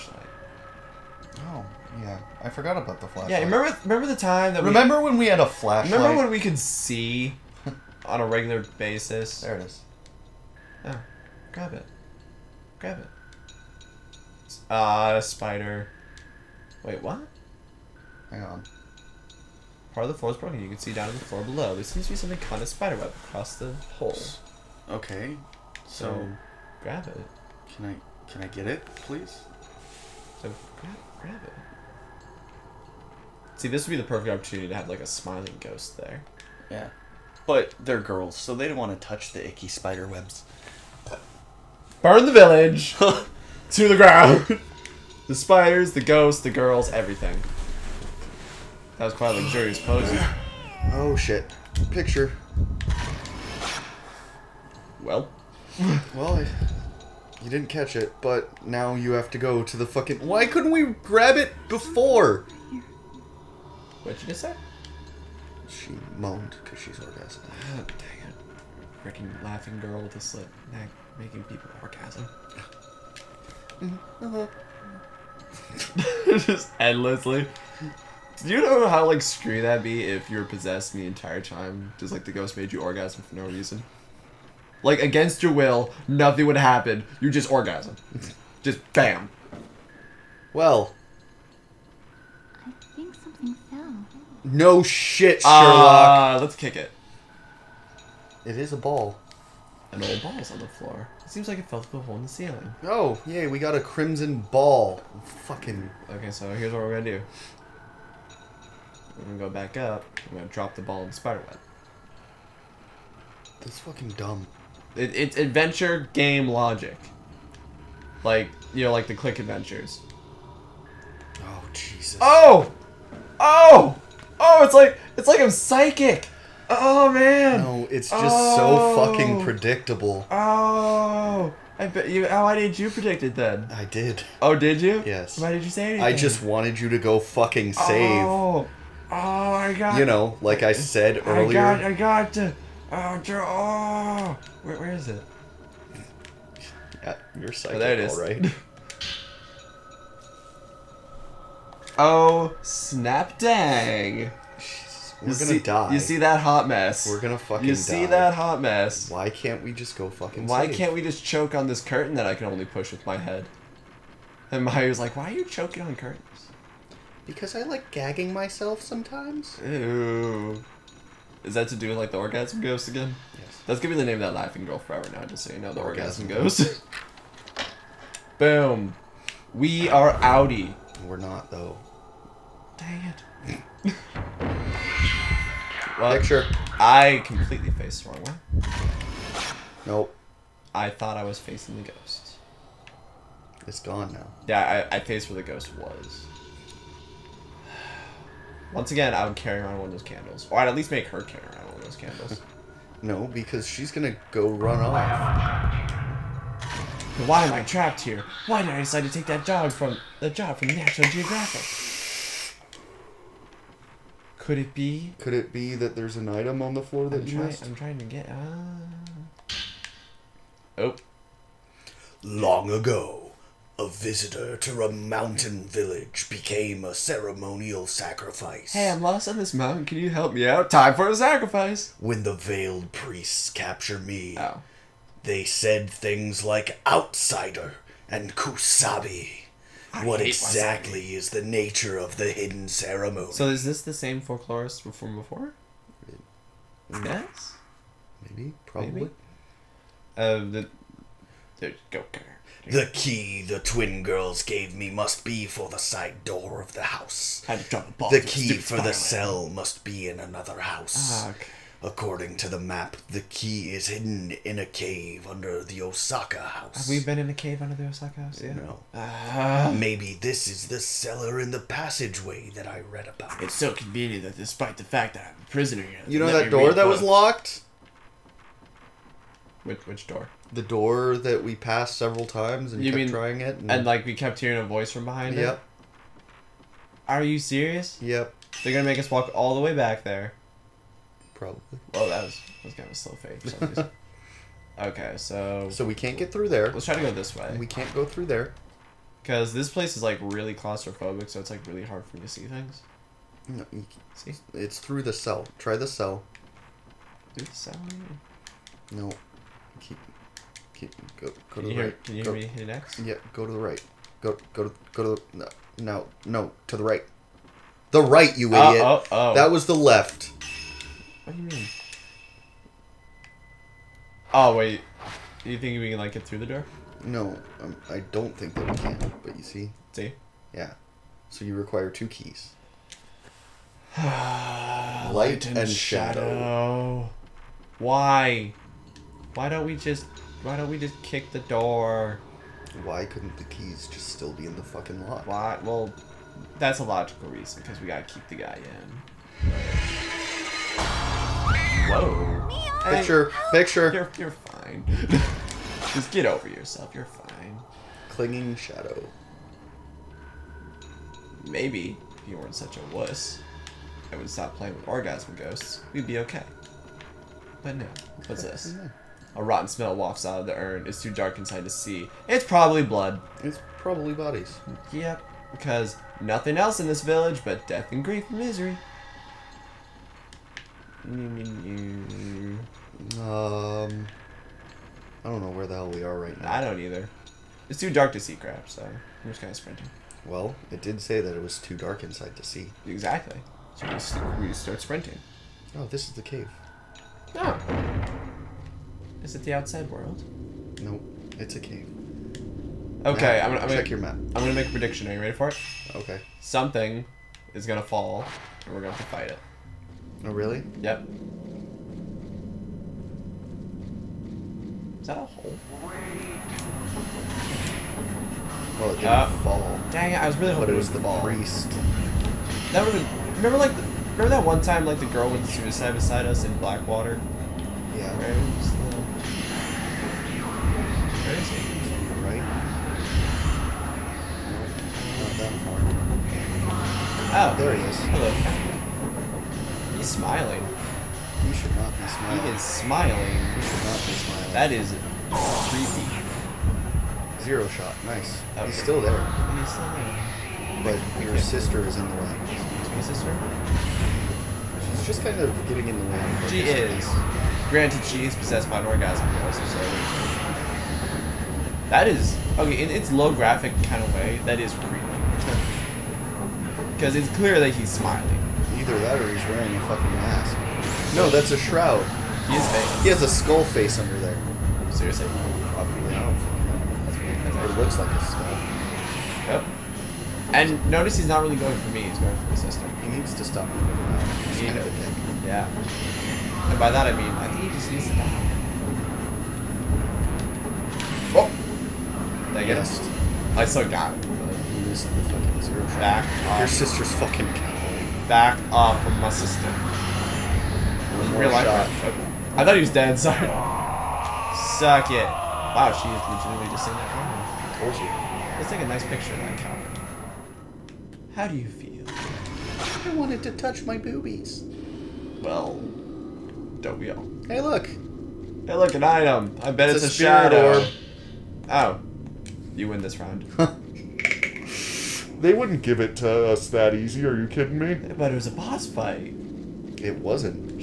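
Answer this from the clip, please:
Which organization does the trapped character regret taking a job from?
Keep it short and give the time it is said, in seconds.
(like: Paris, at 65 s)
National Geographic, at 210 s.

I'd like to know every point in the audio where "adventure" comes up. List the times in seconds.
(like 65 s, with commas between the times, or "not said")
115 s, 119 s.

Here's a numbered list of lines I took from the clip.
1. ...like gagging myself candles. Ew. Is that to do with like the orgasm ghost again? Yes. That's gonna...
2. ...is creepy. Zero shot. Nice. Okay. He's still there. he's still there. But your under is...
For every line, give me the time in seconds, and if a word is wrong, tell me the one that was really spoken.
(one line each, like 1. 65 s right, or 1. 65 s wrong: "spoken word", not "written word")
1. 167 s wrong: "sometimes", not "candles"
2. 444 s wrong: "sister", not "under".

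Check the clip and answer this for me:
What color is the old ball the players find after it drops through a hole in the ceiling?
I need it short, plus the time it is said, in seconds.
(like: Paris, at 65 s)
Crimson, at 103 s.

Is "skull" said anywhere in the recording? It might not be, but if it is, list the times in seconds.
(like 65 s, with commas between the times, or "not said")
473 s, 478 s.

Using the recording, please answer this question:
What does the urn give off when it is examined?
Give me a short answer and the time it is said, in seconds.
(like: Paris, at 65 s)
A rotten smell, at 369 s.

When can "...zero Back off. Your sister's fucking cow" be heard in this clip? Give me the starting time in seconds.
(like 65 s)
495 s.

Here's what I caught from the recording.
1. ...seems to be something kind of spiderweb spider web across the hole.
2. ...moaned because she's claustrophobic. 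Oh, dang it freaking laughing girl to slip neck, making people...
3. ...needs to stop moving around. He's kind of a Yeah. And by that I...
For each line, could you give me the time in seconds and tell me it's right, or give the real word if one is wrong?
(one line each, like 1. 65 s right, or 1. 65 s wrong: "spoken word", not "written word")
1. 21 s right
2. 66 s wrong: "orgasmic", not "claustrophobic"
3. 483 s right.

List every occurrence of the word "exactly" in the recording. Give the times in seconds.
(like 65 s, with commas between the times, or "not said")
240 s, 392 s.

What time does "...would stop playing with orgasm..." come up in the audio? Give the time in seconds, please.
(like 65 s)
364 s.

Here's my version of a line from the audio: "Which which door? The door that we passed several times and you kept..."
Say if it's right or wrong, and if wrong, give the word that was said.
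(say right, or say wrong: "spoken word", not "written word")
right.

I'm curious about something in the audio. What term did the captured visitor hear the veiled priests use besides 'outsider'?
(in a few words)
Kusabi.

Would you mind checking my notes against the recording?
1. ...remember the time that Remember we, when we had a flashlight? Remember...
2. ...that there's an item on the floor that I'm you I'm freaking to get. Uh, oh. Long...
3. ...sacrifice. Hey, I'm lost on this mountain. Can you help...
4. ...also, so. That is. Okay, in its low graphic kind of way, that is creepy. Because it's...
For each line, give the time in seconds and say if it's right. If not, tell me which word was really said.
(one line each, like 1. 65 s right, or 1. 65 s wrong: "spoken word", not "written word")
1. 3 s right
2. 215 s wrong: "trying", not "freaking"
3. 227 s right
4. 459 s right.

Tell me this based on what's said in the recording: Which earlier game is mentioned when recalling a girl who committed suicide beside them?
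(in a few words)
Blackwater.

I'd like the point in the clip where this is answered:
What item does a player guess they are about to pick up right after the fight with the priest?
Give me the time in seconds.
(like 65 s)
520 s.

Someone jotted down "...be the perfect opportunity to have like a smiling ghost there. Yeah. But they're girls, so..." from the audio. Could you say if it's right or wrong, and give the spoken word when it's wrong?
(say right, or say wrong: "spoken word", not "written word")
right.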